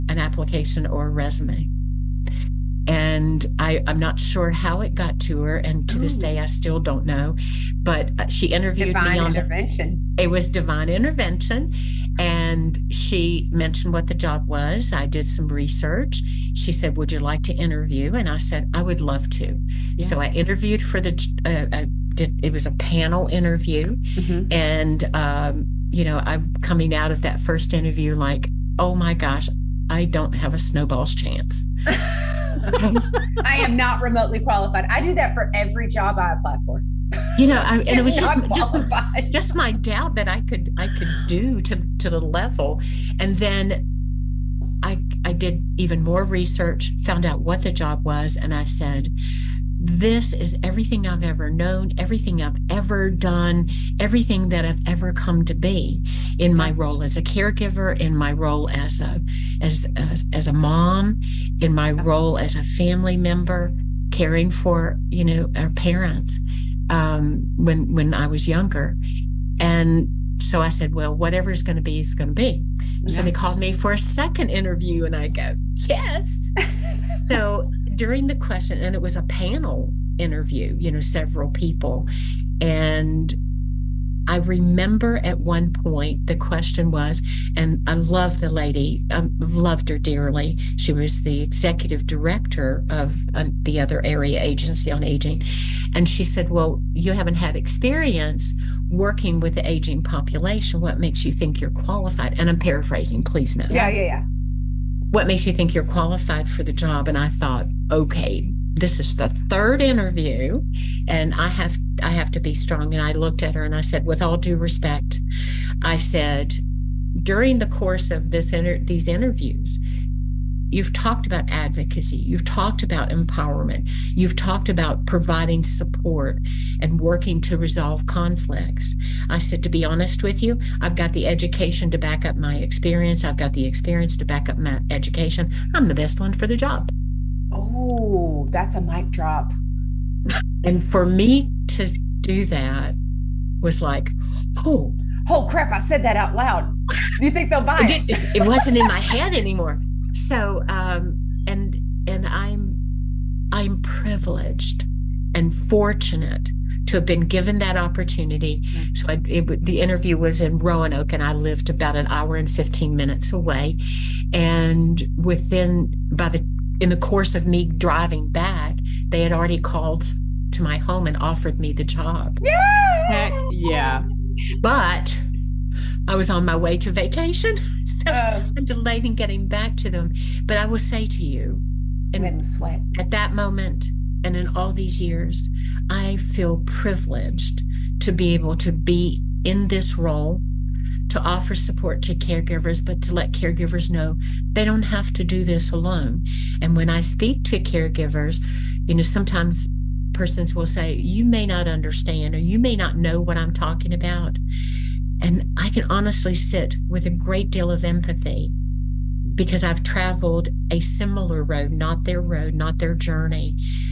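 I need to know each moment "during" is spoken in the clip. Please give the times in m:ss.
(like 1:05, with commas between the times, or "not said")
1:17, 1:57.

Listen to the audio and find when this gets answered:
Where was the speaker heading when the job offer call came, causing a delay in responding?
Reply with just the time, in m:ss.
2:56.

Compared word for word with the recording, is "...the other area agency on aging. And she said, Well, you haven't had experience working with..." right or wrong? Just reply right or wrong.
right.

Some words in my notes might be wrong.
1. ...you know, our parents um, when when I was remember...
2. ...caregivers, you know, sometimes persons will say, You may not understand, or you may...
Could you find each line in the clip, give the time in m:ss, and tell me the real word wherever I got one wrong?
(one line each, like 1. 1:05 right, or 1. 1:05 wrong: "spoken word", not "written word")
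1. 1:05 wrong: "younger", not "remember"
2. 3:17 right.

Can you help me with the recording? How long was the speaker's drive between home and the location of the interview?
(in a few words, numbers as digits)
1 hour 15 minutes.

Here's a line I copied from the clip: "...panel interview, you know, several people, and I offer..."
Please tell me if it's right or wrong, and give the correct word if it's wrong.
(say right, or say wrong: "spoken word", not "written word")
wrong: "remember", not "offer".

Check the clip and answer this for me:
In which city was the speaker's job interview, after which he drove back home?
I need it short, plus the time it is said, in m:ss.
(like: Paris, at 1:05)
Roanoke, at 2:40.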